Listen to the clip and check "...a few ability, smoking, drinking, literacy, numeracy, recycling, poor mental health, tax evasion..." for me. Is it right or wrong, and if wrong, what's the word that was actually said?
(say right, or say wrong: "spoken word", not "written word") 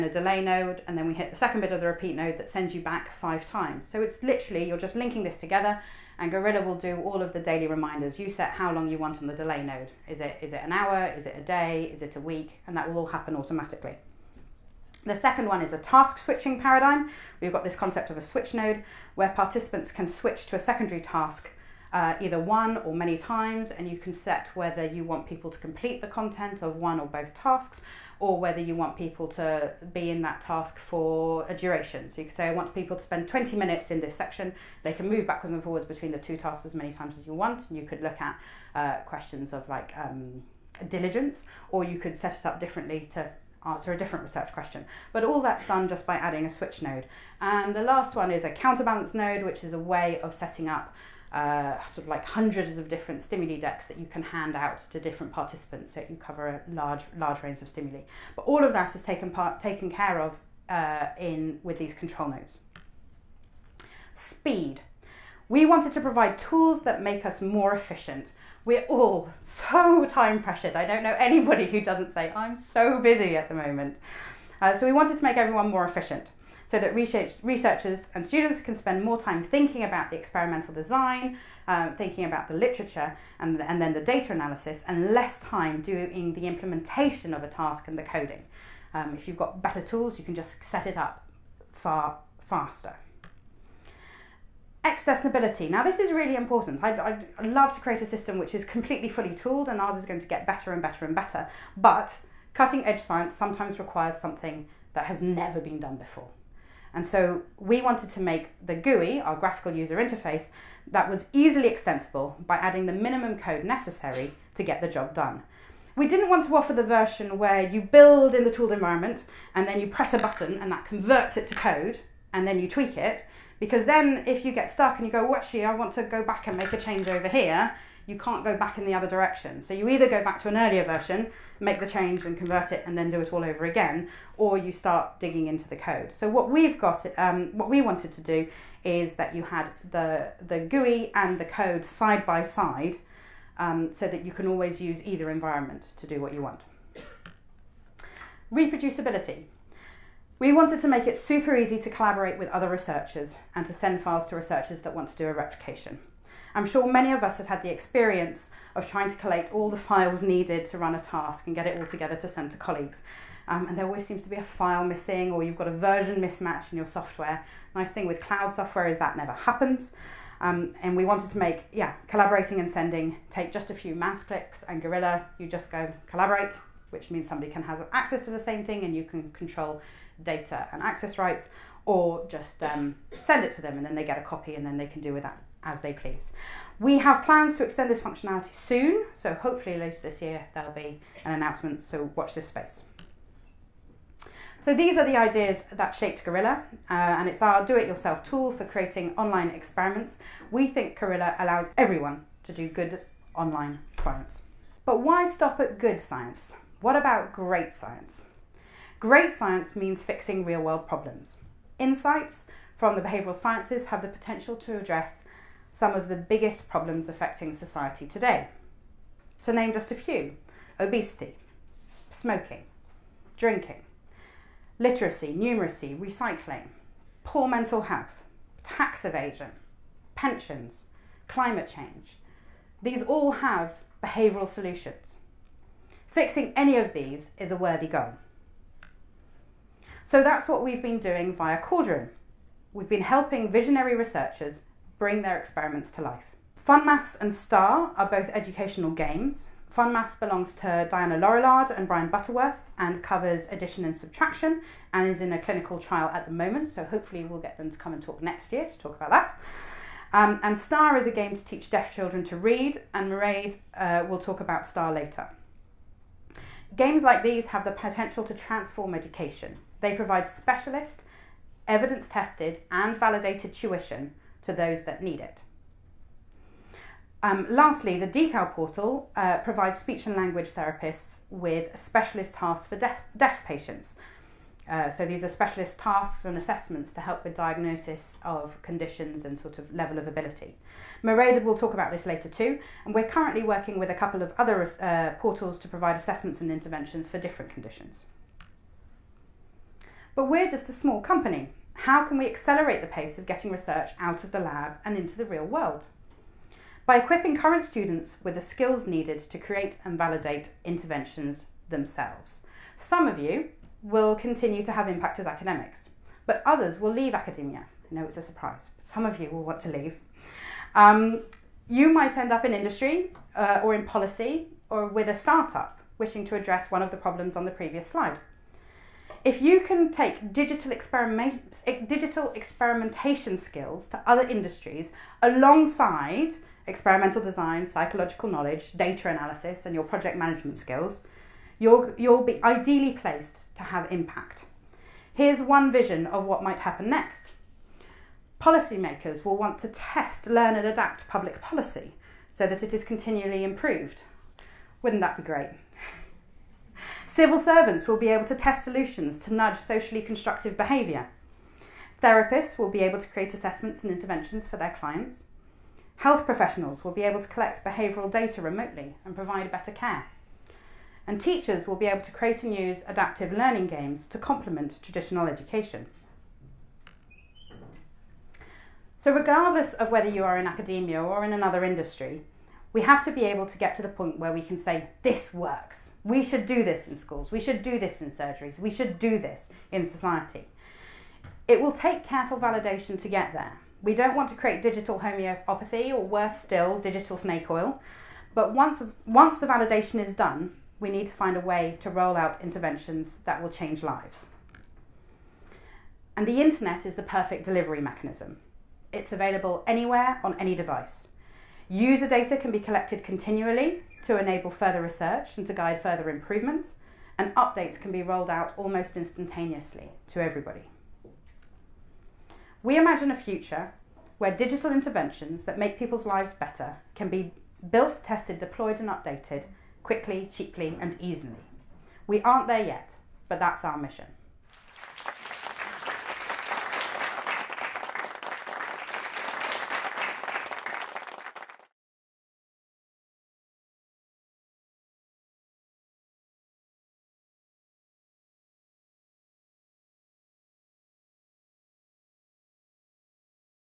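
wrong: "obesity", not "ability".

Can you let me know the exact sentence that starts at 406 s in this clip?
And the internet is the perfect delivery mechanism.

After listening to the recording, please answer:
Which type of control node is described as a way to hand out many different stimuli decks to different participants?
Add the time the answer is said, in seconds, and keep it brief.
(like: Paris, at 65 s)
Counterbalance node, at 48 s.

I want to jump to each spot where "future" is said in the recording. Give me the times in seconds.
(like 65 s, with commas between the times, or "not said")
423 s.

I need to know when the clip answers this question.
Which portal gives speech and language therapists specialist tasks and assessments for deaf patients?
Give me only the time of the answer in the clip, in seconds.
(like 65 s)
278 s.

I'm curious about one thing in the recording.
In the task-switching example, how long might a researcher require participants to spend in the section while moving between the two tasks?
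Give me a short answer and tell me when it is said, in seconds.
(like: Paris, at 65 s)
20 minutes, at 33 s.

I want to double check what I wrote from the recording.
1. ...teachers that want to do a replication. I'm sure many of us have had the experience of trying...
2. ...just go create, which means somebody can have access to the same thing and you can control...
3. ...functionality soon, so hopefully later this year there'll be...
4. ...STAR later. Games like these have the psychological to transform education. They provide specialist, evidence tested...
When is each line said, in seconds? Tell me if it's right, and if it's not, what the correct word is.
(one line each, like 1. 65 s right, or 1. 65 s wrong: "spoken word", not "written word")
1. 154 s wrong: "researchers", not "teachers"
2. 175 s wrong: "collaborate", not "create"
3. 187 s right
4. 264 s wrong: "potential", not "psychological".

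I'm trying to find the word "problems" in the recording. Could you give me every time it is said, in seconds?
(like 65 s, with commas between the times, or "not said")
210 s, 216 s, 326 s.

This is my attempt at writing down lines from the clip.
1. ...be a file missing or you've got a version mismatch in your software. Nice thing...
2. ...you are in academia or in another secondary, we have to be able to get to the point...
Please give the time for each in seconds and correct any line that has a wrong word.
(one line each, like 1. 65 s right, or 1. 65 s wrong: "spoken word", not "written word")
1. 164 s right
2. 380 s wrong: "industry", not "secondary".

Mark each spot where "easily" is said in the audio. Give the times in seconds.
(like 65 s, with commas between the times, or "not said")
111 s, 430 s.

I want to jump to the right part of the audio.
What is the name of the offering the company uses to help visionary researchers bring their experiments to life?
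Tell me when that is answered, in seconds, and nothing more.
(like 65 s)
241 s.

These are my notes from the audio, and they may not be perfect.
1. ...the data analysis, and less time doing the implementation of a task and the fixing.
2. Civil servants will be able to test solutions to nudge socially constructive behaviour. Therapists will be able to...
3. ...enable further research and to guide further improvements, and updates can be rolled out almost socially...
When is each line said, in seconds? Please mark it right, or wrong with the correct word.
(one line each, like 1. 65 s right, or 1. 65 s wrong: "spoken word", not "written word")
1. 83 s wrong: "coding", not "fixing"
2. 357 s right
3. 414 s wrong: "instantaneously", not "socially".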